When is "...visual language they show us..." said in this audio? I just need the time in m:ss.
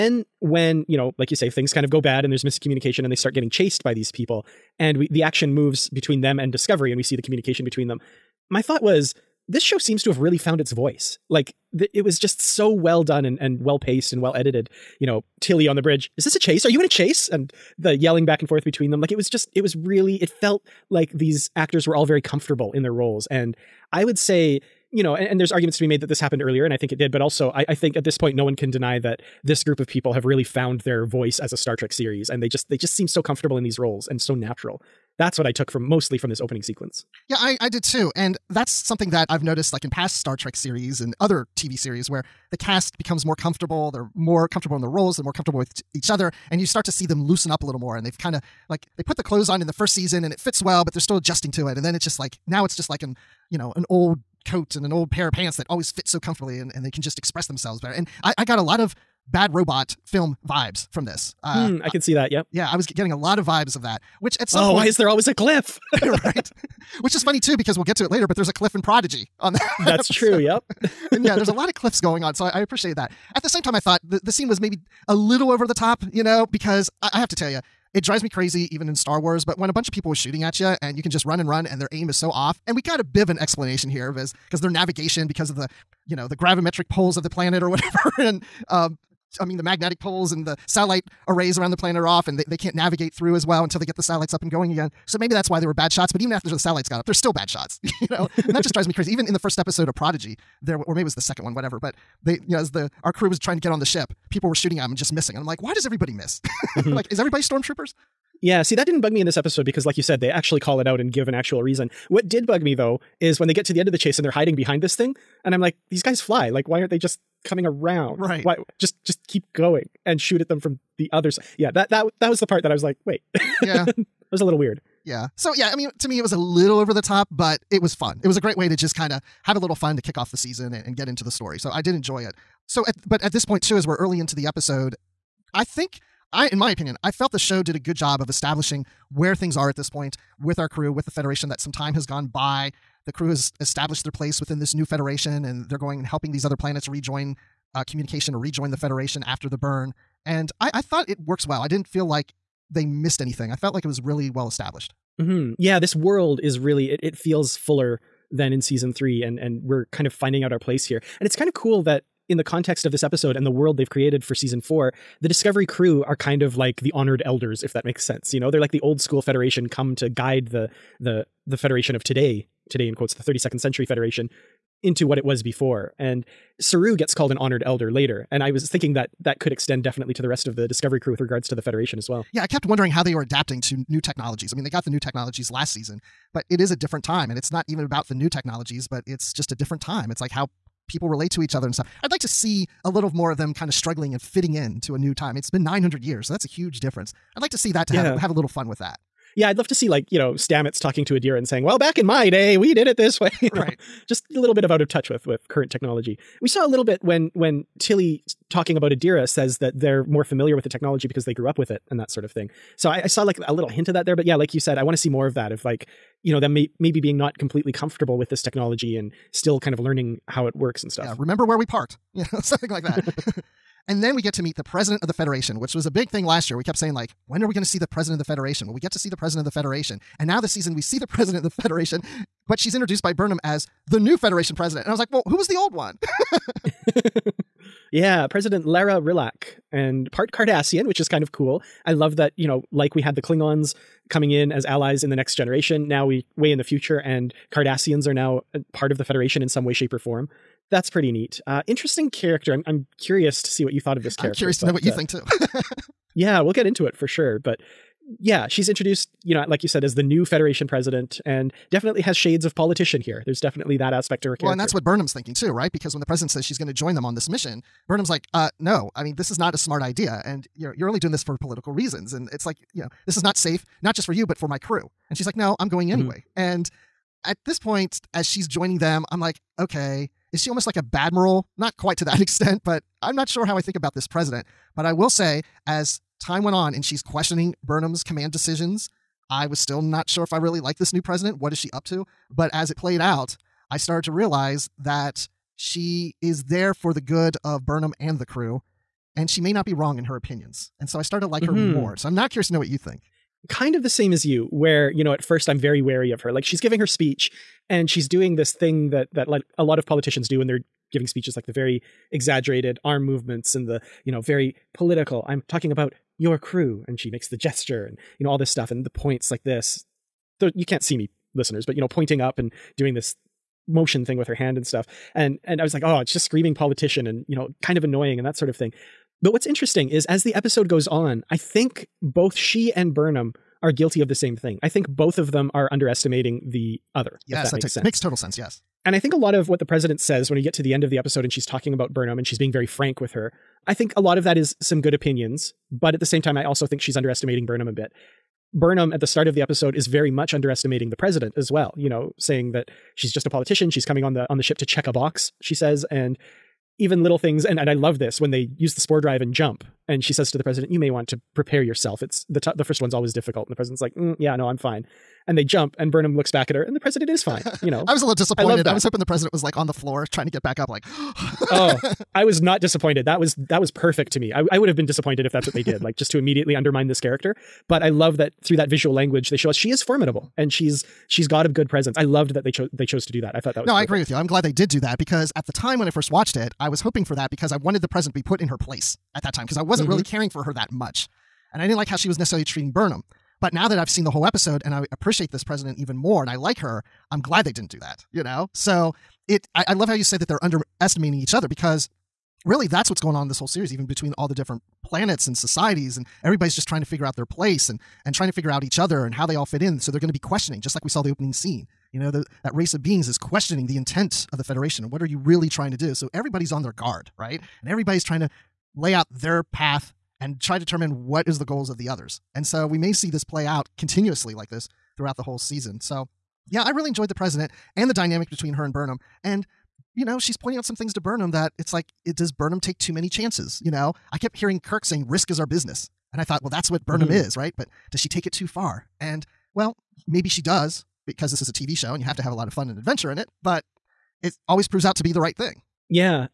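6:18.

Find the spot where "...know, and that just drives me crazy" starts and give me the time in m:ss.
1:38.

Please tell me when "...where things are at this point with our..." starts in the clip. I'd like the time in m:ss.
2:19.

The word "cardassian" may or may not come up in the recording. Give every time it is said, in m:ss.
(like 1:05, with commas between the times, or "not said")
4:00, 4:07.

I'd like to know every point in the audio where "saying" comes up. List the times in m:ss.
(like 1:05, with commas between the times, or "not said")
3:21, 3:46, 5:52, 7:14.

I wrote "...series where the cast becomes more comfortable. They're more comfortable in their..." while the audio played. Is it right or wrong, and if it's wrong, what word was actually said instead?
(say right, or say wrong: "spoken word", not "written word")
right.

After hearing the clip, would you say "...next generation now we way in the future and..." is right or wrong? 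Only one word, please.
right.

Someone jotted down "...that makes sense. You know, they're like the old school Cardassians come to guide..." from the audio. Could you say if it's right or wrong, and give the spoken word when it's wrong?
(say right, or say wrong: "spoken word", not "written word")
wrong: "Federation", not "Cardassians".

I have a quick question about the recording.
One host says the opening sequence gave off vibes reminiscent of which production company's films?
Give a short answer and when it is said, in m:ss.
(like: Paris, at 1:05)
Bad Robot, at 0:59.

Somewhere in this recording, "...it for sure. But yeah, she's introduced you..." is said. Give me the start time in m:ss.
4:16.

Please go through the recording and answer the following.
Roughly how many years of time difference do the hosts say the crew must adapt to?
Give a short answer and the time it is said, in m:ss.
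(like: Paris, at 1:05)
900, at 3:15.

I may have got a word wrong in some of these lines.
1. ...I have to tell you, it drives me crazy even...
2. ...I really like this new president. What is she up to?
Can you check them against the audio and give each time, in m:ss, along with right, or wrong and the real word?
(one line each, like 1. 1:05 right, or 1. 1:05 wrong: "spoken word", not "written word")
1. 1:17 right
2. 4:50 right.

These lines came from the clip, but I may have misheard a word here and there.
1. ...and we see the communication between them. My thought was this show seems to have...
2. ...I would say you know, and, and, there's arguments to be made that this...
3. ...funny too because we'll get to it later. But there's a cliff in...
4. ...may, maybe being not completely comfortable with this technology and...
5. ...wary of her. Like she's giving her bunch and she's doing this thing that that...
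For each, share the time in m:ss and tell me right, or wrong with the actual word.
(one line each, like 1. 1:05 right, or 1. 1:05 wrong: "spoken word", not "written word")
1. 0:06 right
2. 0:23 right
3. 1:07 right
4. 3:36 right
5. 5:05 wrong: "speech", not "bunch".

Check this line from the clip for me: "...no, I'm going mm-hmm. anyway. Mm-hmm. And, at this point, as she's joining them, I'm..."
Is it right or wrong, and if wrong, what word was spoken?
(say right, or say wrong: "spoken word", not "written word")
right.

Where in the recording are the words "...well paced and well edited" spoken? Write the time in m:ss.
0:13.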